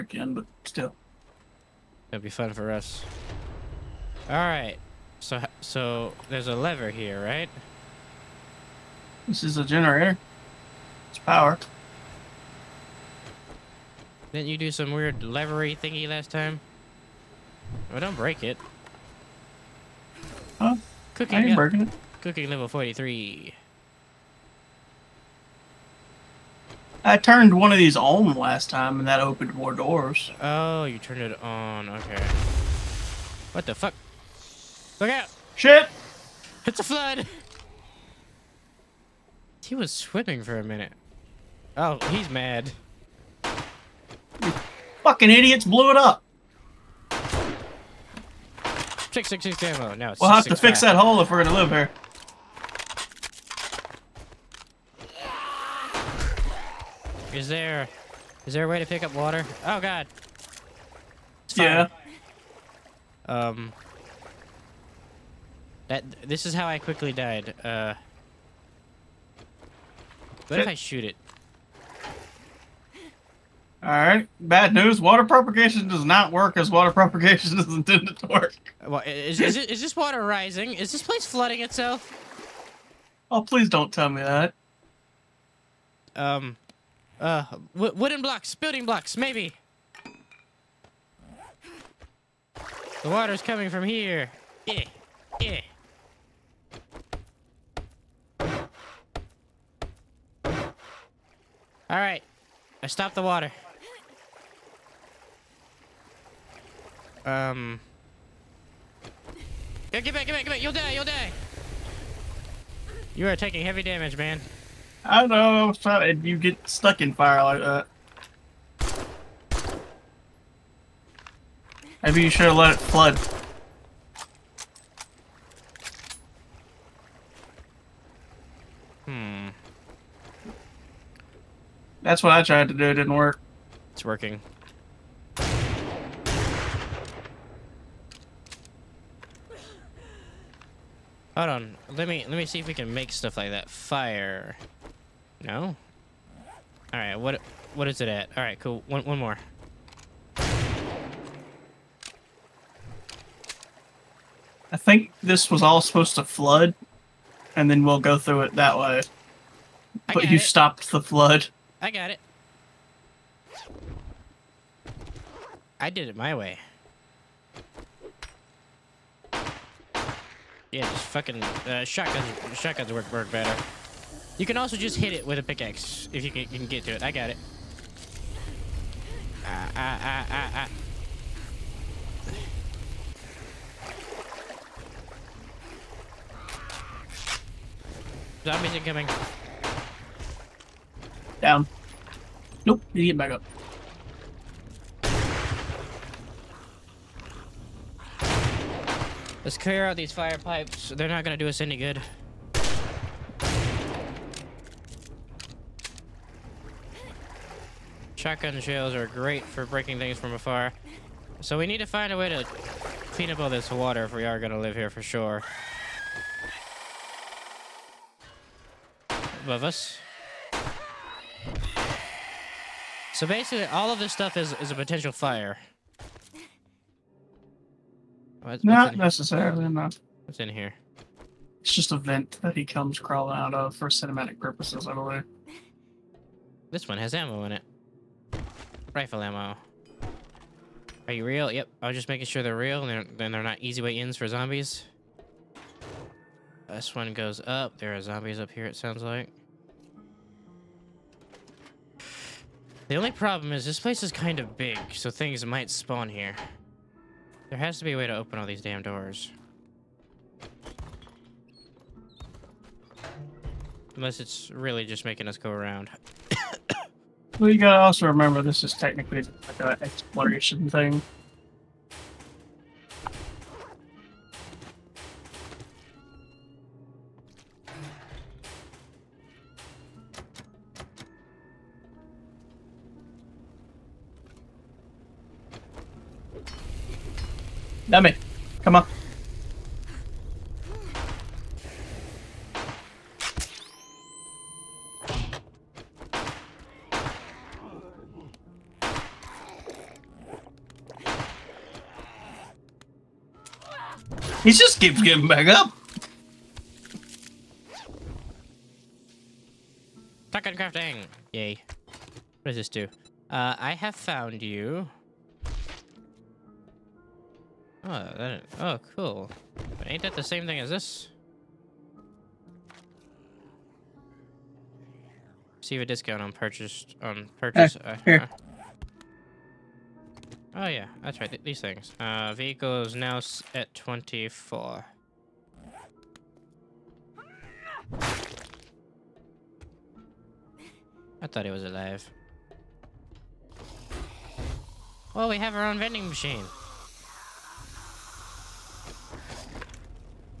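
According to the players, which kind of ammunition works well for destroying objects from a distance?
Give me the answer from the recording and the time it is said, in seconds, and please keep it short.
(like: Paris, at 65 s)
Shotgun shells, at 208 s.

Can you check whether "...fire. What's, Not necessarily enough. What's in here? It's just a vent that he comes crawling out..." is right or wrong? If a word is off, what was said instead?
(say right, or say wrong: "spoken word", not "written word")
right.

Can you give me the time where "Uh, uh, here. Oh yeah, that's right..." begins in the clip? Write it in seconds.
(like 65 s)
327 s.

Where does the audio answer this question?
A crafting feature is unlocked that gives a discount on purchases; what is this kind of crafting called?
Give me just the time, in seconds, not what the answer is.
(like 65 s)
310 s.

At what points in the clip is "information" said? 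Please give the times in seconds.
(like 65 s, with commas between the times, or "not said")
not said.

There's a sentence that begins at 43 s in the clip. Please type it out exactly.
You fucking idiots blew it up!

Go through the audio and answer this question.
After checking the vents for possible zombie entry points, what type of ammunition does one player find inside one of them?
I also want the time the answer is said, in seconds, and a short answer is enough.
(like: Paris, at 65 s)
Rifle ammo, at 238 s.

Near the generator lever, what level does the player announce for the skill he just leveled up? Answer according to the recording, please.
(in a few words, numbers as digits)
43.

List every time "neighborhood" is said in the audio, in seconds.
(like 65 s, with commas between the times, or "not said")
not said.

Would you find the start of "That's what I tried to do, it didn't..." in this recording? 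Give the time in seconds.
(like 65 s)
132 s.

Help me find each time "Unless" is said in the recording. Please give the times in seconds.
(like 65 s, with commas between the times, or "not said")
263 s.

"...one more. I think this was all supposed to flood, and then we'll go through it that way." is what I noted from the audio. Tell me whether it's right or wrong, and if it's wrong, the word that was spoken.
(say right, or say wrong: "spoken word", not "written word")
right.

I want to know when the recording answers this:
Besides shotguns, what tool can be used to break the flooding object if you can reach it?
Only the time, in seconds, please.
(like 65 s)
175 s.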